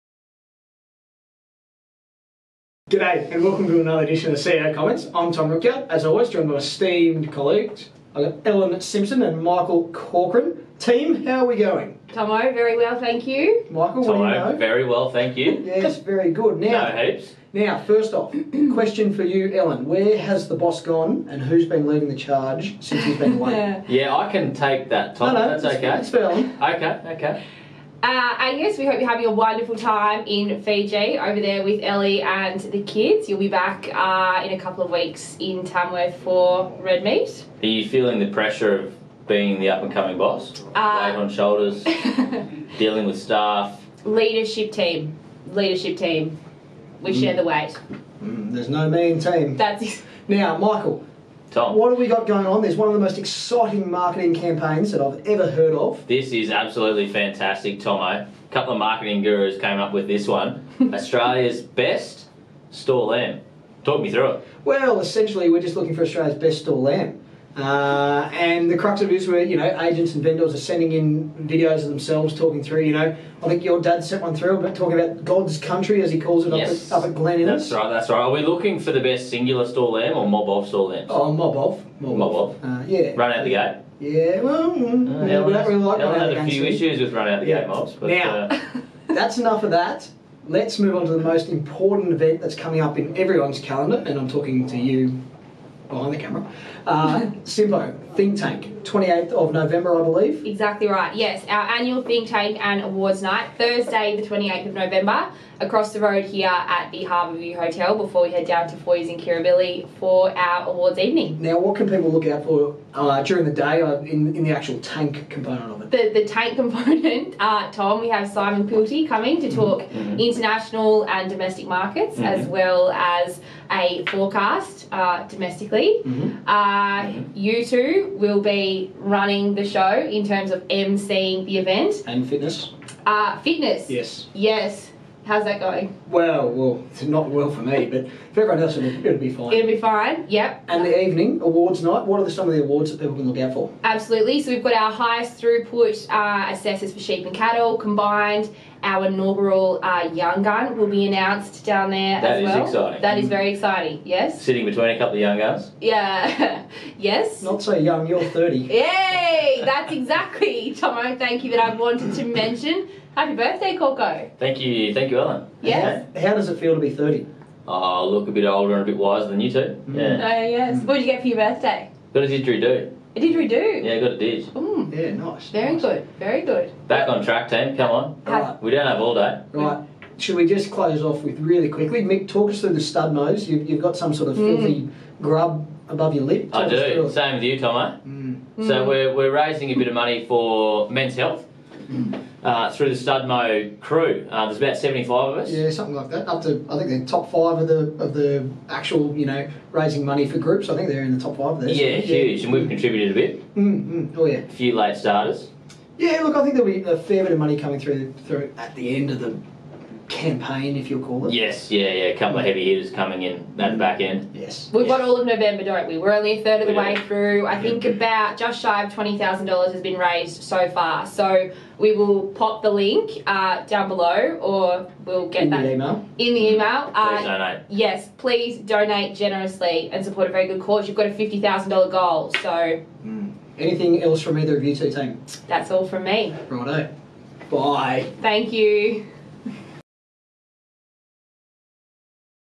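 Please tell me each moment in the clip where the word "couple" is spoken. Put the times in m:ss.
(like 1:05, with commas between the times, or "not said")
0:34, 0:58, 2:34, 3:32.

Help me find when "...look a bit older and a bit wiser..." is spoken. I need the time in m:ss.
2:48.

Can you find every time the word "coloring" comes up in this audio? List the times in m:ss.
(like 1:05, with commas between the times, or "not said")
not said.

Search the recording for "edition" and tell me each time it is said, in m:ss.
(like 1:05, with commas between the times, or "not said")
0:04.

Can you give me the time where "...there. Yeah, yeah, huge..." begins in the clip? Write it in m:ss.
3:21.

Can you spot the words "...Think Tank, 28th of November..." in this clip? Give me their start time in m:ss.
1:38.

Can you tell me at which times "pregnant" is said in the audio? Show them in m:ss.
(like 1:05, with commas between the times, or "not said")
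not said.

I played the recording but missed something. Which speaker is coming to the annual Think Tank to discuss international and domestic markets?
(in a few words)
Simon Quilty.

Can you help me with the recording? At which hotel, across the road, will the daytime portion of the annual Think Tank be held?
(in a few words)
Harbour View Hotel.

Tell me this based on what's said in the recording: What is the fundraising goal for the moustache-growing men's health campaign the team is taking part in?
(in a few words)
$50,000.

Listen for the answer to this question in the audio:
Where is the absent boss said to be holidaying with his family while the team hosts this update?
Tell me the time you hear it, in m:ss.
0:30.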